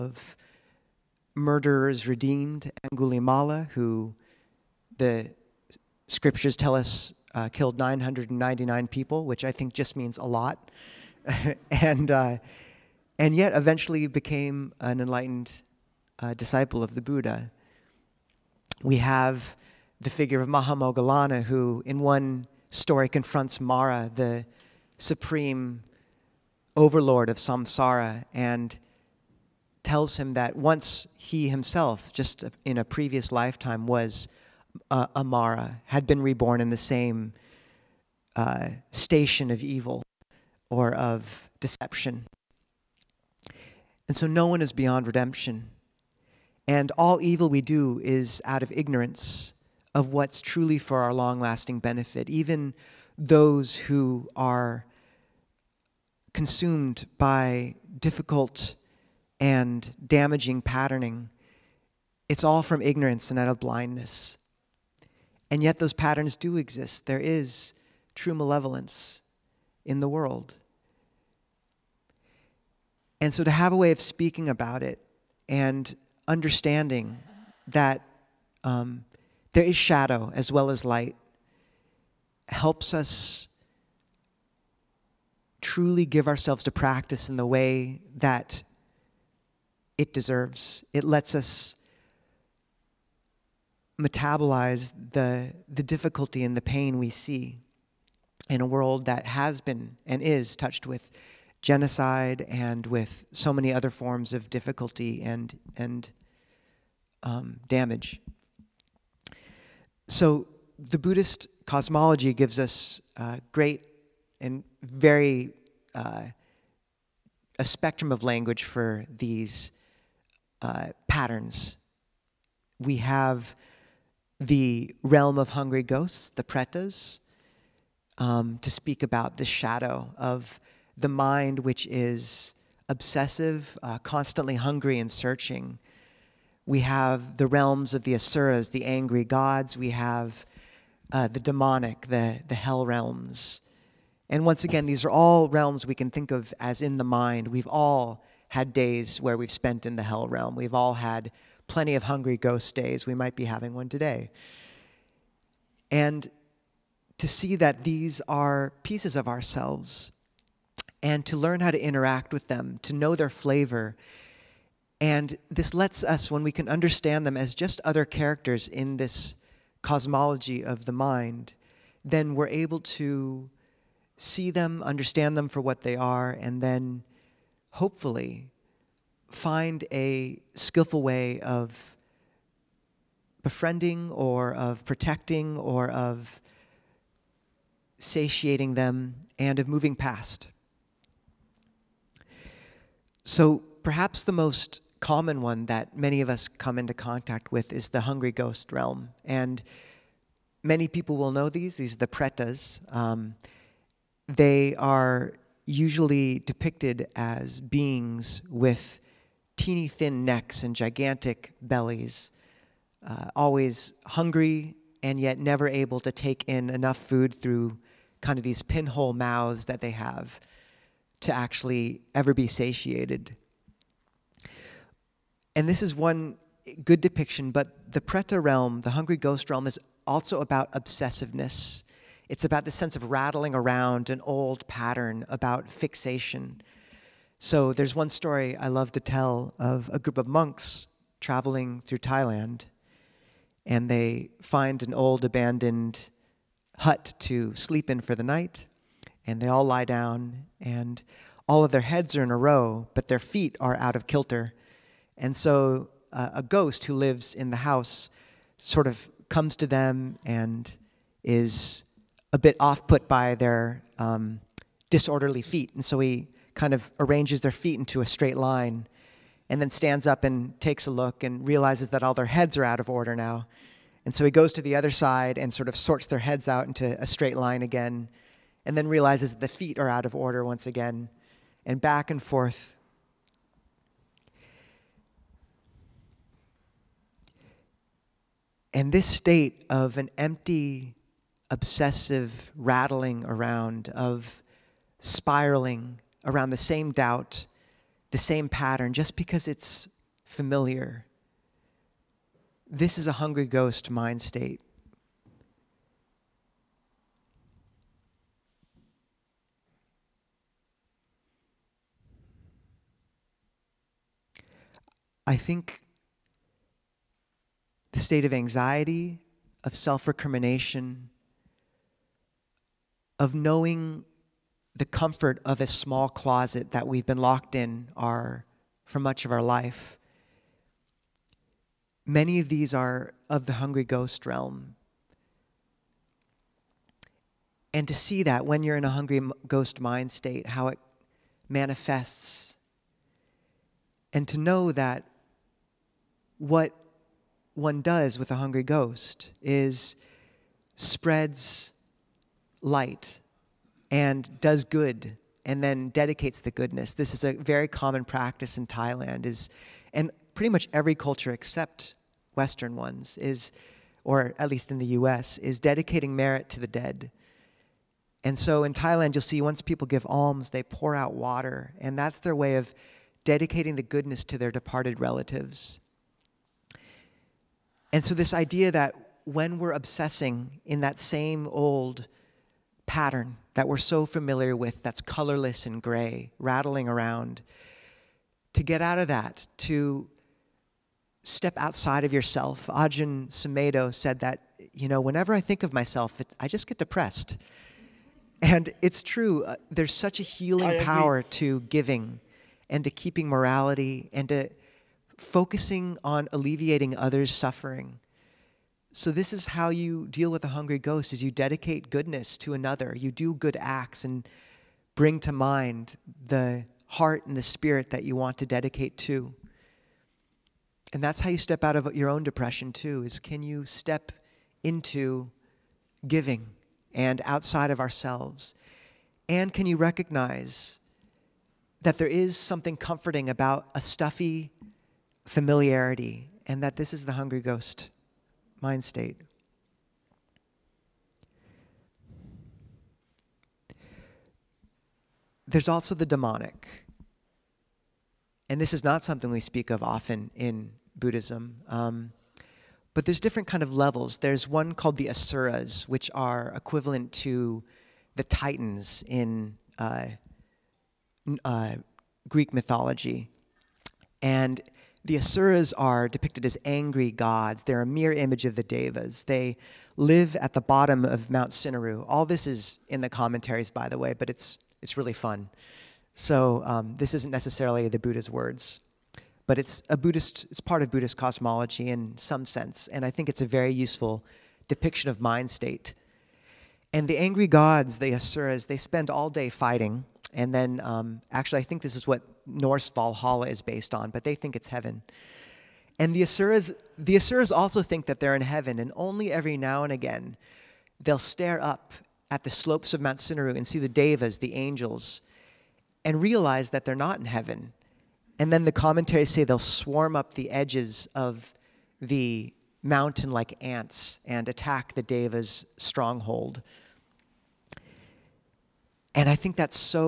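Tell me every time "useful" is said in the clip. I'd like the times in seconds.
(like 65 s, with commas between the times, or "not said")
483 s.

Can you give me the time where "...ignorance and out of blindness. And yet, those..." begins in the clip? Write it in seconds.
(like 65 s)
62 s.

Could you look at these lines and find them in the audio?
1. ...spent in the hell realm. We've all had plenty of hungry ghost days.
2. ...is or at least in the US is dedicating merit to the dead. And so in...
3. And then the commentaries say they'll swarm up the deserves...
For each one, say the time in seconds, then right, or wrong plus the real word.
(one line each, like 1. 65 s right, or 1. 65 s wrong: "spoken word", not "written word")
1. 149 s right
2. 363 s right
3. 508 s wrong: "edges", not "deserves".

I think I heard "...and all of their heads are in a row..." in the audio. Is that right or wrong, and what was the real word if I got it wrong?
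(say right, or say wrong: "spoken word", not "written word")
right.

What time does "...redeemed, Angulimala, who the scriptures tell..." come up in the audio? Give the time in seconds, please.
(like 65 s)
2 s.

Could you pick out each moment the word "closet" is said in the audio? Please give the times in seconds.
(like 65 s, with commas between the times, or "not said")
326 s.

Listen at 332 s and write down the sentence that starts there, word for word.
Many of these are of the hungry ghost realm.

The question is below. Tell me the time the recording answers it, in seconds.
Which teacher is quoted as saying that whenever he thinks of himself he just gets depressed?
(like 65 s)
392 s.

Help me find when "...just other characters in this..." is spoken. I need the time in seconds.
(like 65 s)
167 s.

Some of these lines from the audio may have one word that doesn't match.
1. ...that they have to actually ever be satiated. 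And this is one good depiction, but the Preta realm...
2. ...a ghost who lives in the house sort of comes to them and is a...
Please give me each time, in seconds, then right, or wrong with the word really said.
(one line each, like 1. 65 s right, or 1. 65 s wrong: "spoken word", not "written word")
1. 219 s right
2. 256 s right.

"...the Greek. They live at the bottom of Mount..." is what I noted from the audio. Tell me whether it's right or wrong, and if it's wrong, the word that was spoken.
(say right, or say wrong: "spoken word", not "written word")
wrong: "Devas", not "Greek".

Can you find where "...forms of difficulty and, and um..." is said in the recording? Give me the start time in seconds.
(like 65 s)
103 s.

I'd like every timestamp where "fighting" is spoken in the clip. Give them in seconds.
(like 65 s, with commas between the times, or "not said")
489 s.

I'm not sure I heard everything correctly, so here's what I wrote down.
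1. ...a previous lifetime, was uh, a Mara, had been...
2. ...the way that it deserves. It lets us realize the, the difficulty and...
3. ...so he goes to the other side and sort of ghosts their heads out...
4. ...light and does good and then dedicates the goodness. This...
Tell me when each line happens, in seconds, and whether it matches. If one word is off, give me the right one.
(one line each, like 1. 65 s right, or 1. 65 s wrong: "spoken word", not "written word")
1. 32 s right
2. 87 s wrong: "metabolize", not "realize"
3. 274 s wrong: "sorts", not "ghosts"
4. 352 s right.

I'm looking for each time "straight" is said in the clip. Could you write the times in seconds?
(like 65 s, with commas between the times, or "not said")
268 s, 277 s.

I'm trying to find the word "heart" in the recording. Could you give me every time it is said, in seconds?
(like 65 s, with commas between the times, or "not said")
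416 s.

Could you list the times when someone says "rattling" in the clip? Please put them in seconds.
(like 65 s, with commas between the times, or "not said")
233 s, 292 s, 386 s.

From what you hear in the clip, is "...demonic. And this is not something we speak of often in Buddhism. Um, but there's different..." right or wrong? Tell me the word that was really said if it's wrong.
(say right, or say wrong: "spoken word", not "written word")
right.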